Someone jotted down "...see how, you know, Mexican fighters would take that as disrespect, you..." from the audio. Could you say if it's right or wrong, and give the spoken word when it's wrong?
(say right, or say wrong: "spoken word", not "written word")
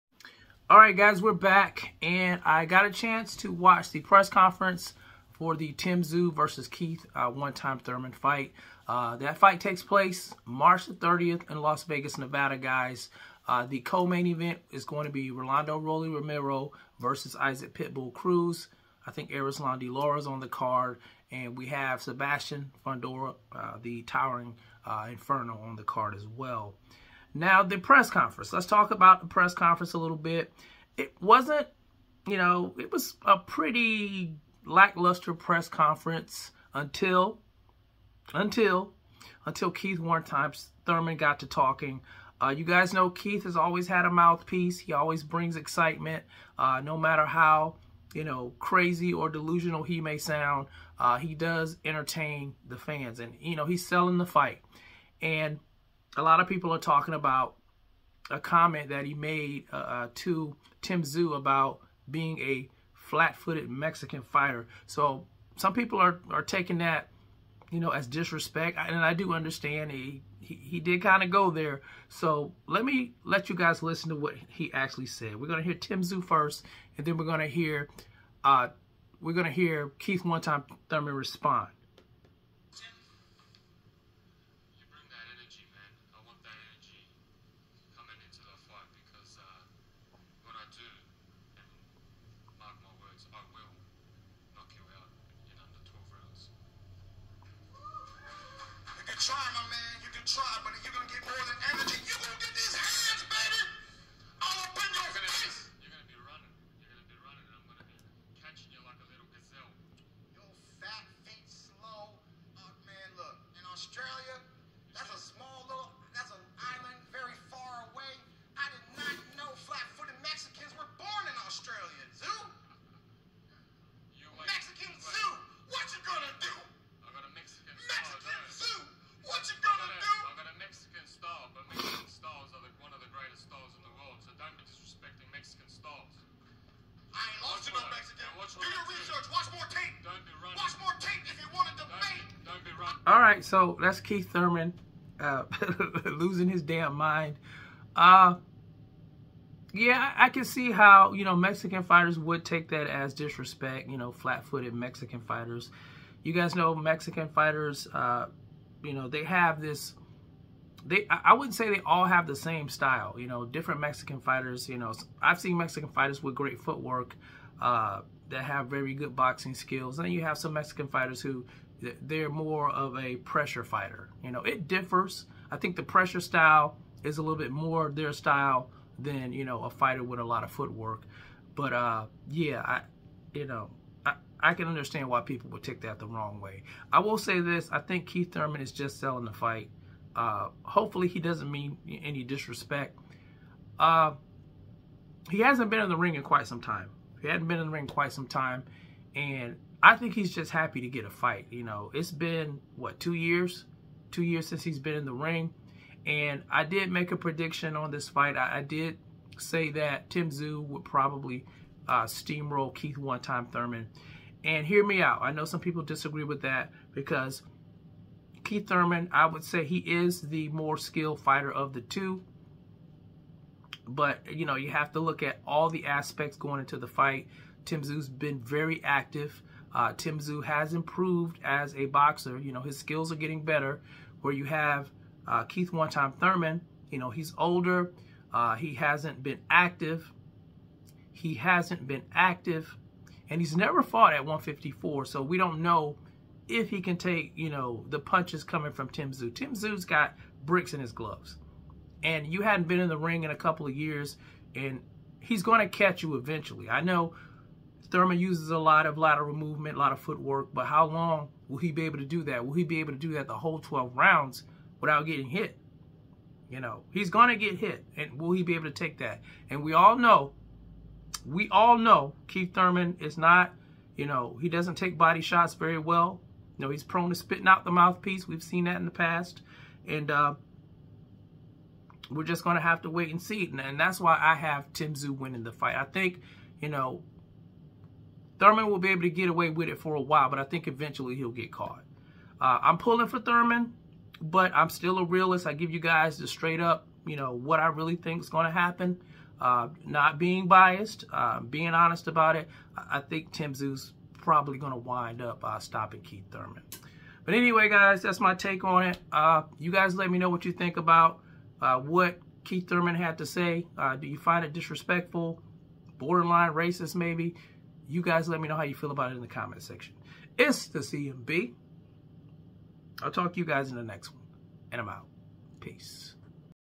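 right.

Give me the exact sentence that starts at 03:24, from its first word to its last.
Two years since he's been in the ring.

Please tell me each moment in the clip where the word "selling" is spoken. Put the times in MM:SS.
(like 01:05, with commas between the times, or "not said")
00:53, 03:08.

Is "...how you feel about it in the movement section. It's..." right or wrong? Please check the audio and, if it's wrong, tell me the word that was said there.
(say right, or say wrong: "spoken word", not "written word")
wrong: "comment", not "movement".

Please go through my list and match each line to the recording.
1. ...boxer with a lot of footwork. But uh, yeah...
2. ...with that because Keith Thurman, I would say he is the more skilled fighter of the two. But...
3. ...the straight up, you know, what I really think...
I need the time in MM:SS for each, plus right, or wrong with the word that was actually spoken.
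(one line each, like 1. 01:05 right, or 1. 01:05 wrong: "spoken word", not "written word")
1. 02:59 wrong: "fighter", not "boxer"
2. 03:36 right
3. 04:56 right.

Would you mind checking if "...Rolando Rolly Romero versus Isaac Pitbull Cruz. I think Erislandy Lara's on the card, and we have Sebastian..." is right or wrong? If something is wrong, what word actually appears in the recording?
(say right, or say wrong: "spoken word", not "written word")
right.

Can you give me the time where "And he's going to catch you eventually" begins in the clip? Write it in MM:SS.
04:14.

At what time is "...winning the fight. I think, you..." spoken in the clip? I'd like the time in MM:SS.
04:45.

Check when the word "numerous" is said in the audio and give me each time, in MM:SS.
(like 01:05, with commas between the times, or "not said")
not said.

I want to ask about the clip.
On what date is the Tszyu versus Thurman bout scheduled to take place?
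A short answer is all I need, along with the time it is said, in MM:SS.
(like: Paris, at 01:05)
March 30th, at 00:10.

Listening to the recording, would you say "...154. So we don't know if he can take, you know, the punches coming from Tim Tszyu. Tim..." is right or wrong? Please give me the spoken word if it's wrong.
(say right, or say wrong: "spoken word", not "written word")
right.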